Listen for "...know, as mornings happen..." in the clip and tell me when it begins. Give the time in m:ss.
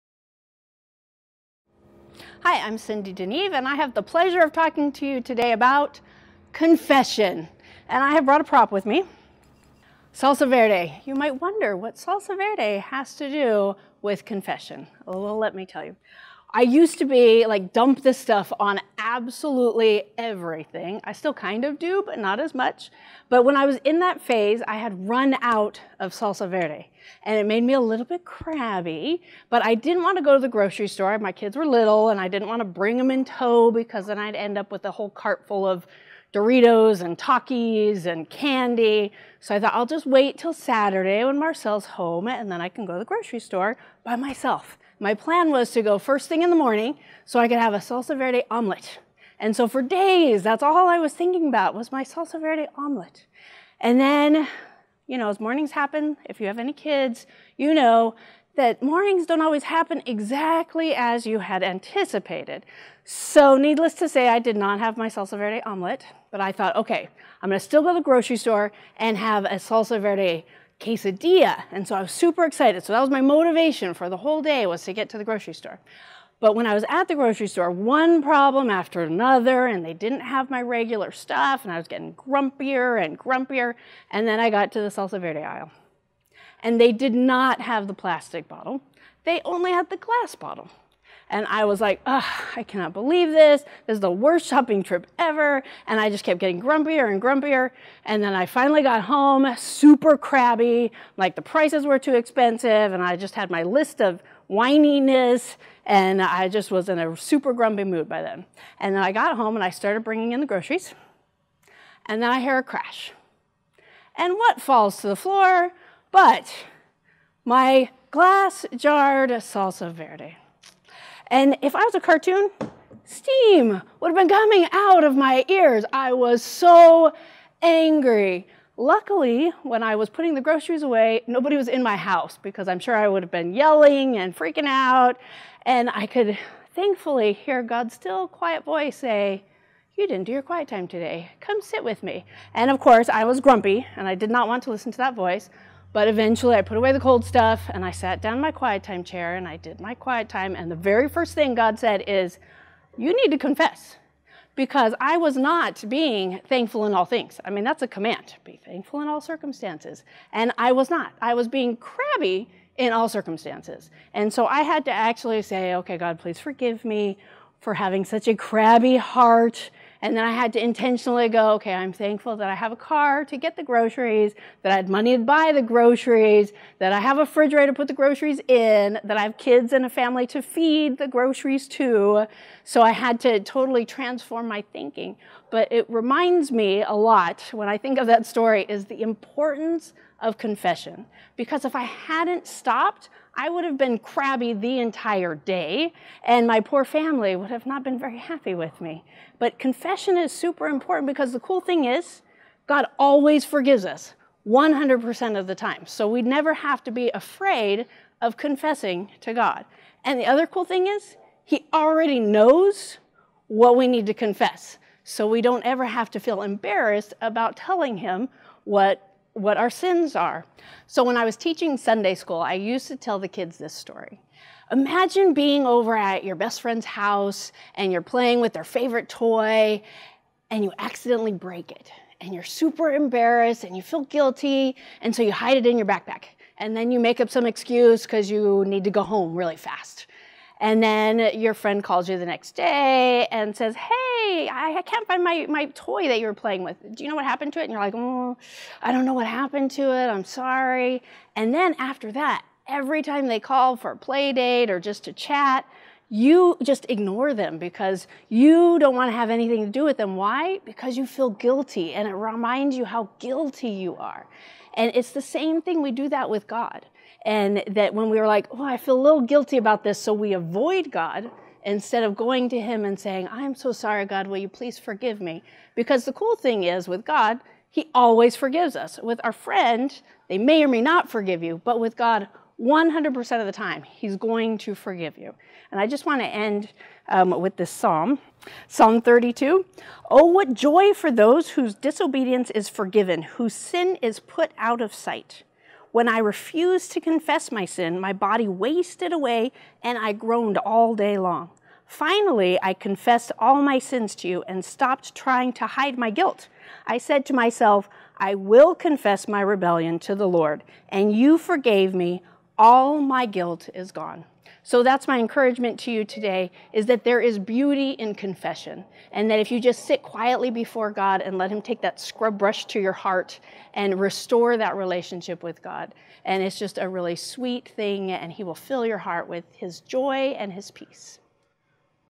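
0:55.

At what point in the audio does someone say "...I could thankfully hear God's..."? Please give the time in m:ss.
2:15.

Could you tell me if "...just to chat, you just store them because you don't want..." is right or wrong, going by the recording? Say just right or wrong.
wrong.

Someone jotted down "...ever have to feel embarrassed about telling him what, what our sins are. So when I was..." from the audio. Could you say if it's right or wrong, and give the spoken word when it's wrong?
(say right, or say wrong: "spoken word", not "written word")
right.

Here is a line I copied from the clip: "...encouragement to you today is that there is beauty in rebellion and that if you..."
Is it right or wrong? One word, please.
wrong.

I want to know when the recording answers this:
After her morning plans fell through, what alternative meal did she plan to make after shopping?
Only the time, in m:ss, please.
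1:09.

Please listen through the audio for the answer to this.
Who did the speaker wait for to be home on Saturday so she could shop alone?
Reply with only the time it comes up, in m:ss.
0:41.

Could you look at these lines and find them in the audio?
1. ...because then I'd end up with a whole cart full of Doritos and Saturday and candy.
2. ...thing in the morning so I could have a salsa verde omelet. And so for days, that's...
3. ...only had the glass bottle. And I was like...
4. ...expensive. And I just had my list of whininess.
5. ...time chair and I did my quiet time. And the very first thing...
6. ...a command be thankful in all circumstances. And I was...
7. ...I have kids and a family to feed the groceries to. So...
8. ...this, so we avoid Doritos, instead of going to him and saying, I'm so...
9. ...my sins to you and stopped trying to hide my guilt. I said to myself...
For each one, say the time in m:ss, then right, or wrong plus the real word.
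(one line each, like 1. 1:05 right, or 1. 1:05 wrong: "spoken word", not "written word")
1. 0:33 wrong: "Takis", not "Saturday"
2. 0:46 right
3. 1:29 right
4. 1:42 right
5. 2:28 right
6. 2:37 right
7. 2:59 right
8. 4:29 wrong: "God", not "Doritos"
9. 5:03 right.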